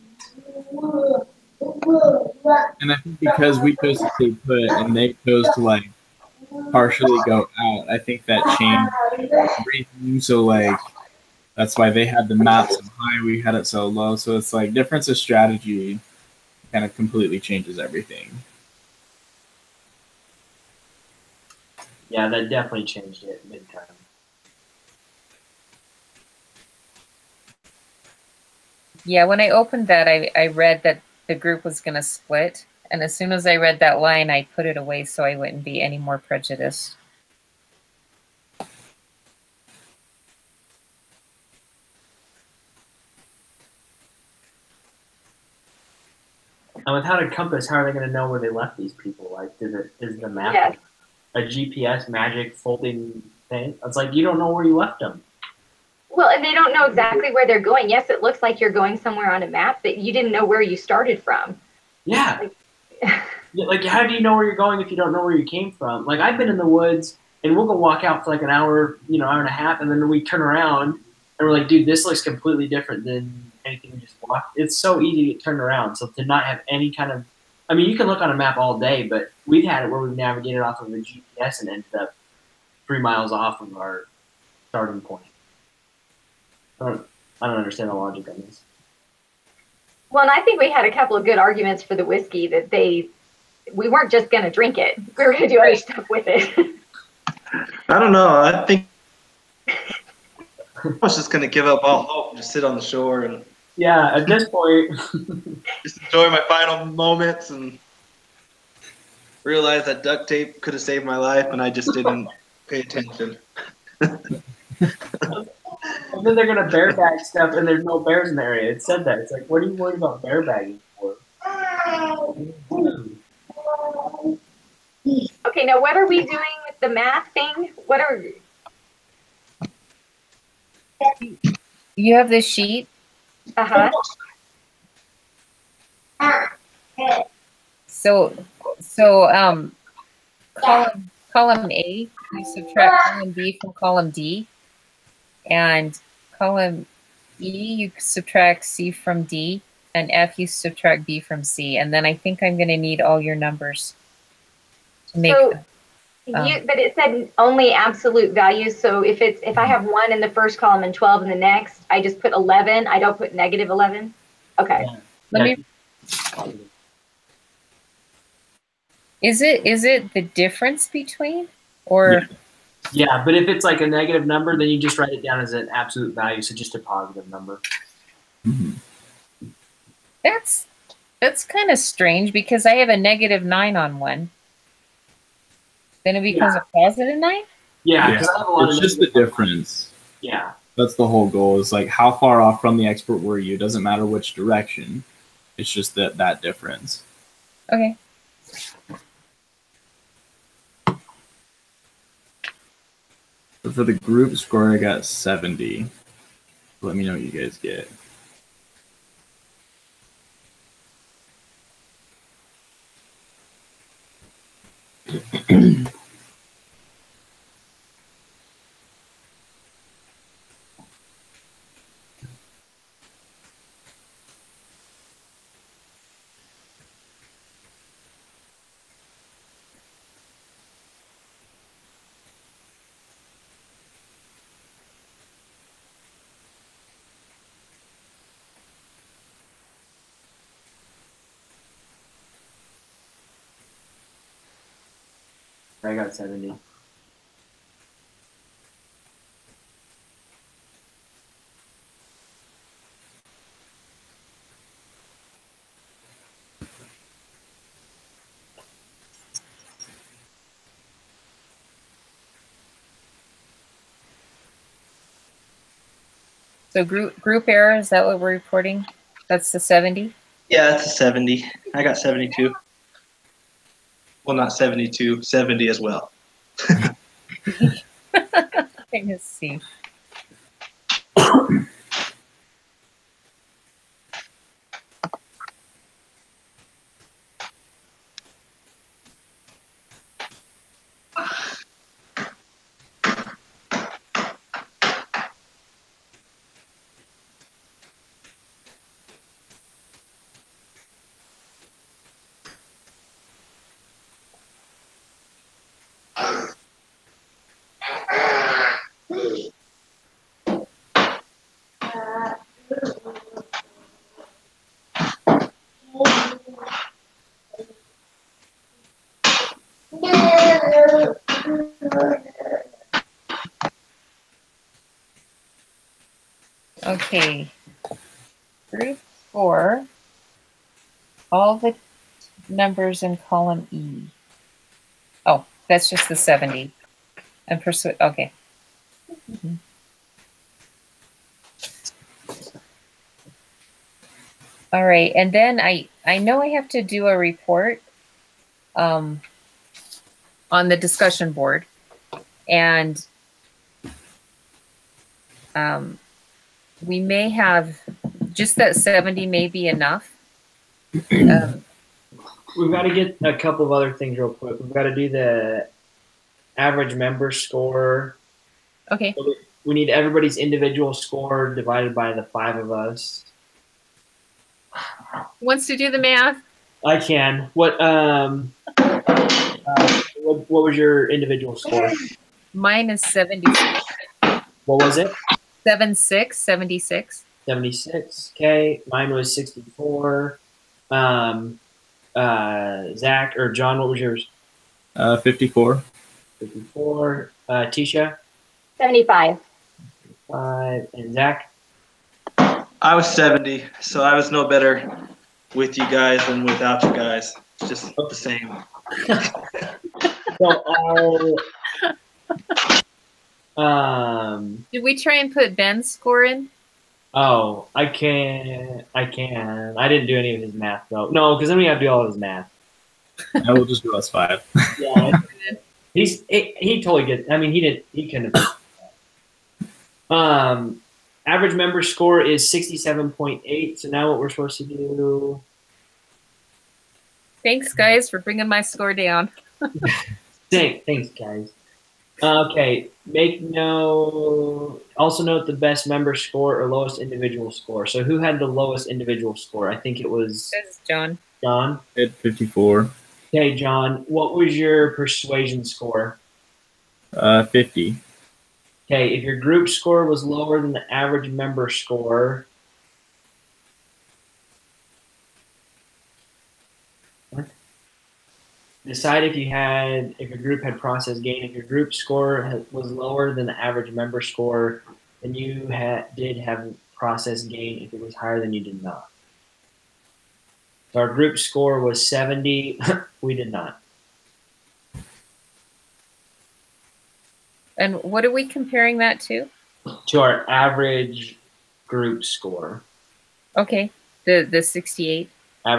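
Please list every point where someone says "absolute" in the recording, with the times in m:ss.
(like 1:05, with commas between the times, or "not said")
2:37, 2:55.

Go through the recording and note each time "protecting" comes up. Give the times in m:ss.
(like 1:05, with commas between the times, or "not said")
not said.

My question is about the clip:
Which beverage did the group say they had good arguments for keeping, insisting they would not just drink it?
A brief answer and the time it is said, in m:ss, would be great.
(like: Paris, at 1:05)
whiskey, at 1:32.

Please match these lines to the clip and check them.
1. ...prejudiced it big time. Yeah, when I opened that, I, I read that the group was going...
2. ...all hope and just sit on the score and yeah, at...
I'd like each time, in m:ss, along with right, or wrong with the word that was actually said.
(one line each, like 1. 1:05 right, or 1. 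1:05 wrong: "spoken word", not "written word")
1. 0:22 wrong: "changed", not "prejudiced"
2. 1:41 wrong: "shore", not "score".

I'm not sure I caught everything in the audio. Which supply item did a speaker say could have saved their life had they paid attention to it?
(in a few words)
duct tape.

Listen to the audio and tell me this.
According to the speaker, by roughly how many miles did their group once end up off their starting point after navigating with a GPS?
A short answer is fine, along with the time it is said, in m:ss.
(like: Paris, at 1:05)
3 miles, at 1:22.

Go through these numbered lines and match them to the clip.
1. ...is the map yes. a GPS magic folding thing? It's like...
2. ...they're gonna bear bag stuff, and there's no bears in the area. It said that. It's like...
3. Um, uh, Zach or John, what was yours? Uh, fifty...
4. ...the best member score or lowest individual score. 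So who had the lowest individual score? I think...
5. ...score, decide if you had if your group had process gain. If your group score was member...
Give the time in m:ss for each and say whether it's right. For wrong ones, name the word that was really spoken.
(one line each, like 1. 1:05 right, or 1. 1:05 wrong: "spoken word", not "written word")
1. 0:50 right
2. 1:56 right
3. 6:30 right
4. 7:25 right
5. 7:41 wrong: "lower", not "member".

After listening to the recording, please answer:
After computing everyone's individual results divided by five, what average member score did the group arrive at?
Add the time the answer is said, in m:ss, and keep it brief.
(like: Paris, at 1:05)
67.8, at 7:12.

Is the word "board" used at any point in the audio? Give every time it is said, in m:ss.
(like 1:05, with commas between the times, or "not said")
5:51.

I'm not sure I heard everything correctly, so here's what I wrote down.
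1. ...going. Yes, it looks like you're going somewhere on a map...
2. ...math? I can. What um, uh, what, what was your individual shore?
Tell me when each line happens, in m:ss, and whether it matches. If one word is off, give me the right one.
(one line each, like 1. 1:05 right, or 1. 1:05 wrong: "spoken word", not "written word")
1. 0:57 right
2. 6:15 wrong: "score", not "shore".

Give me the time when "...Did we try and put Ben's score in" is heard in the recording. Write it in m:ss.
6:54.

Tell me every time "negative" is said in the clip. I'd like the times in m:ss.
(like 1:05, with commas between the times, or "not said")
2:43, 2:53, 3:02.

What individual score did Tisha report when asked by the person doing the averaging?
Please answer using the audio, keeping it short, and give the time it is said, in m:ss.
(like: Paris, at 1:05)
75, at 6:38.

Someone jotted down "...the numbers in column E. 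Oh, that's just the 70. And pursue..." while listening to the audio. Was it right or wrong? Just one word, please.
right.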